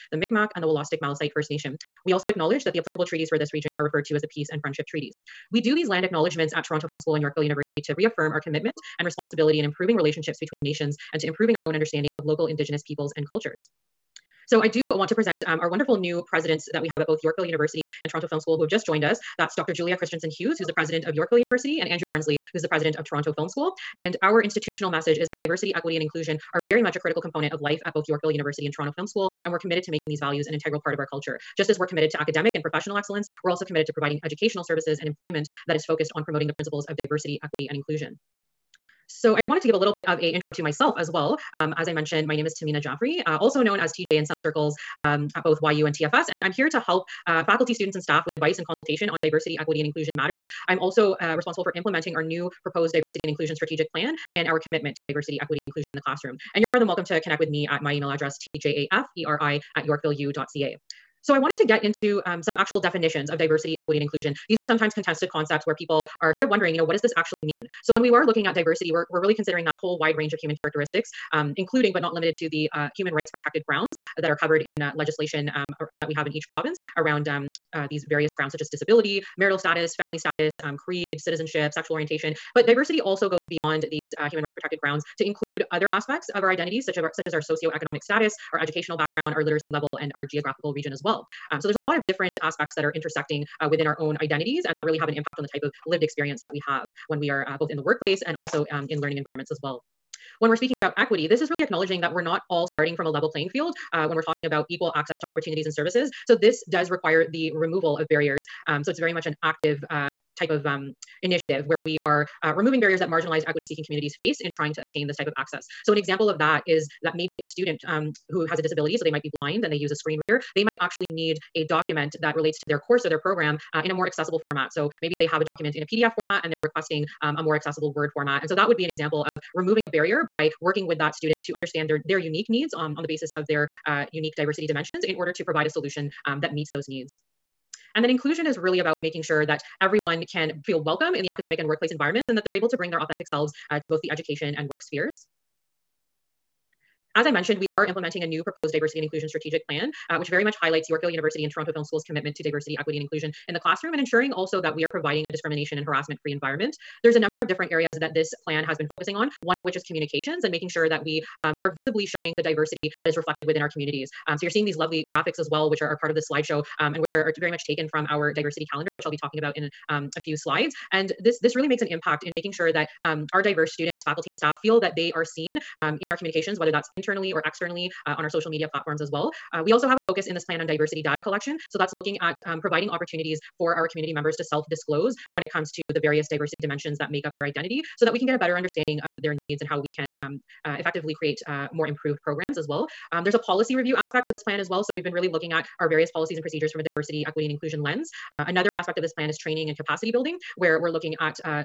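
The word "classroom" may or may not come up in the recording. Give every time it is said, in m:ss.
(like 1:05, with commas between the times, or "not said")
0:56, 2:33.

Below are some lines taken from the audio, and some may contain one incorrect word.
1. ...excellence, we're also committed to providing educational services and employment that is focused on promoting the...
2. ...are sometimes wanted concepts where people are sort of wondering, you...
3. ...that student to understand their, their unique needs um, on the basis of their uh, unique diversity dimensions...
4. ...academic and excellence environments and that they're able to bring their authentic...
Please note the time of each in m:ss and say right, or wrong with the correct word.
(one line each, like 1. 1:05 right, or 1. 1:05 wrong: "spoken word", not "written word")
1. 0:32 right
2. 1:04 wrong: "contested", not "wanted"
3. 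2:10 right
4. 2:21 wrong: "workplace", not "excellence".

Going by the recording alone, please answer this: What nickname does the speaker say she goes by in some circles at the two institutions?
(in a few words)
TJ.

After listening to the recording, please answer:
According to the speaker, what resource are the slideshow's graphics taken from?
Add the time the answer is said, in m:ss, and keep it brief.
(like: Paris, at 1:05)
diversity calendar, at 2:48.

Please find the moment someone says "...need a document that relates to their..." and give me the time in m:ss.
2:01.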